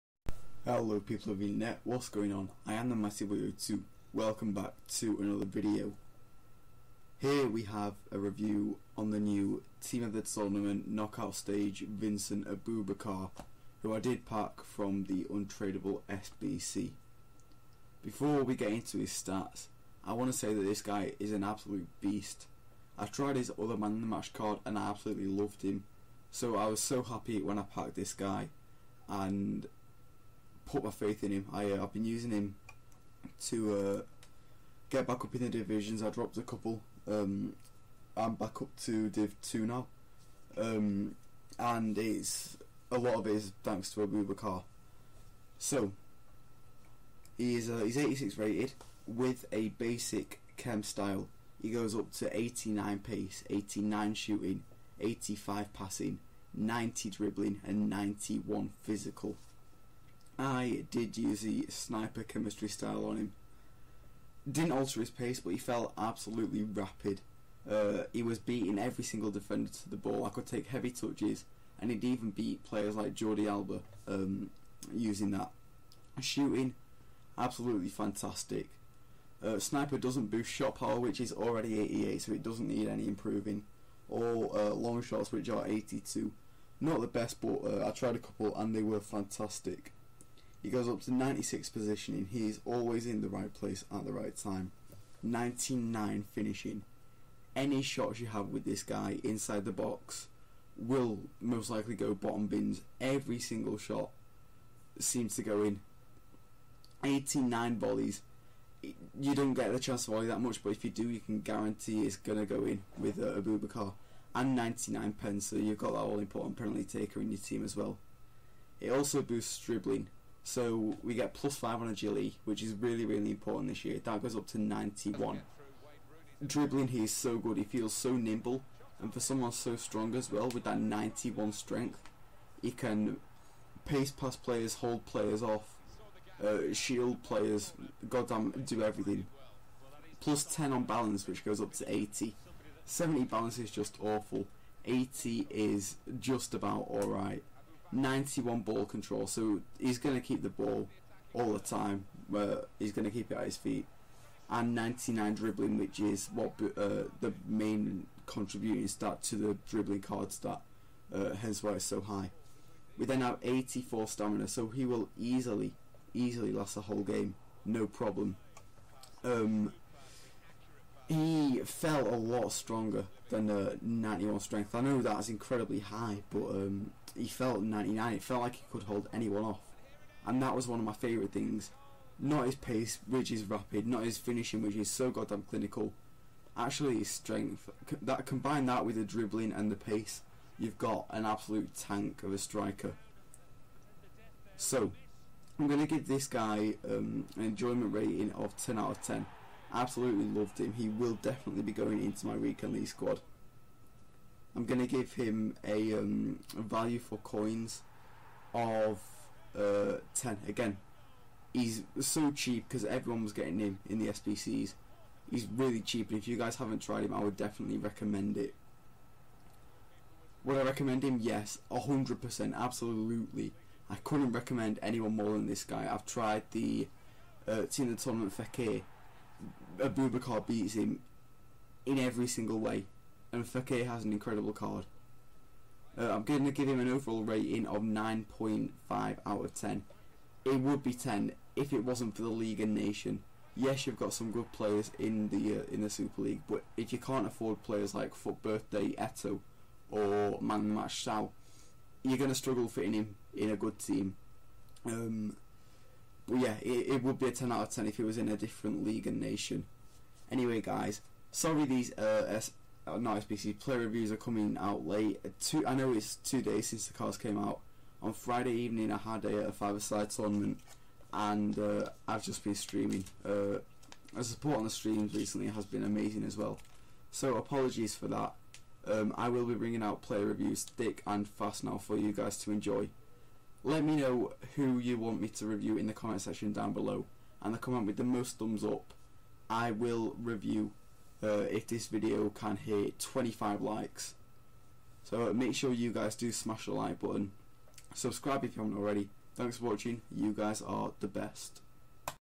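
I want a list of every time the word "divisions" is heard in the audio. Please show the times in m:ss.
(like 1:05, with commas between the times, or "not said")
0:35.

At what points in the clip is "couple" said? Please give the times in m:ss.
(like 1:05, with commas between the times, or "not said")
0:36, 1:28.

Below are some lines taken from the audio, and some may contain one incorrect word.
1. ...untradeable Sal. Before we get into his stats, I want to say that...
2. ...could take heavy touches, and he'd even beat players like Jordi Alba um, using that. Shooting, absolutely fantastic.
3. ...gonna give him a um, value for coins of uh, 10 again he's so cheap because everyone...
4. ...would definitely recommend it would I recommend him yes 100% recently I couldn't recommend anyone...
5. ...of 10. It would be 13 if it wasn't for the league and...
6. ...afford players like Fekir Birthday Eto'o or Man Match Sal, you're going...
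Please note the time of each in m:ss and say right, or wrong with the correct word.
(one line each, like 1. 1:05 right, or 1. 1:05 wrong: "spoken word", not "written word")
1. 0:15 wrong: "SBC", not "Sal"
2. 1:10 right
3. 3:24 right
4. 3:37 wrong: "absolutely", not "recently"
5. 3:59 wrong: "10", not "13"
6. 4:07 wrong: "FUT", not "Fekir".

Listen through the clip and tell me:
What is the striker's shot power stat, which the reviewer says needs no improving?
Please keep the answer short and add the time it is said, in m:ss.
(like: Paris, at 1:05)
88, at 1:21.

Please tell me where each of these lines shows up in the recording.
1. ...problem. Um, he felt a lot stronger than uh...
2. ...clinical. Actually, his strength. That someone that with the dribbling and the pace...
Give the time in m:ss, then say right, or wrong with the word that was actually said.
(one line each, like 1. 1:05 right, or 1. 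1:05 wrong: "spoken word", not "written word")
1. 2:47 right
2. 3:05 wrong: "combine", not "someone".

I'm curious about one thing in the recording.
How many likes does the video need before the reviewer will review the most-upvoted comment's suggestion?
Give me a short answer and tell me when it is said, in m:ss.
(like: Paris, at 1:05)
25, at 4:52.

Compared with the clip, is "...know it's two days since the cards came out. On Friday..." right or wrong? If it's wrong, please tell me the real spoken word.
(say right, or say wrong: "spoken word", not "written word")
right.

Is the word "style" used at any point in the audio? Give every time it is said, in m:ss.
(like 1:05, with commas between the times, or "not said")
0:50, 1:02.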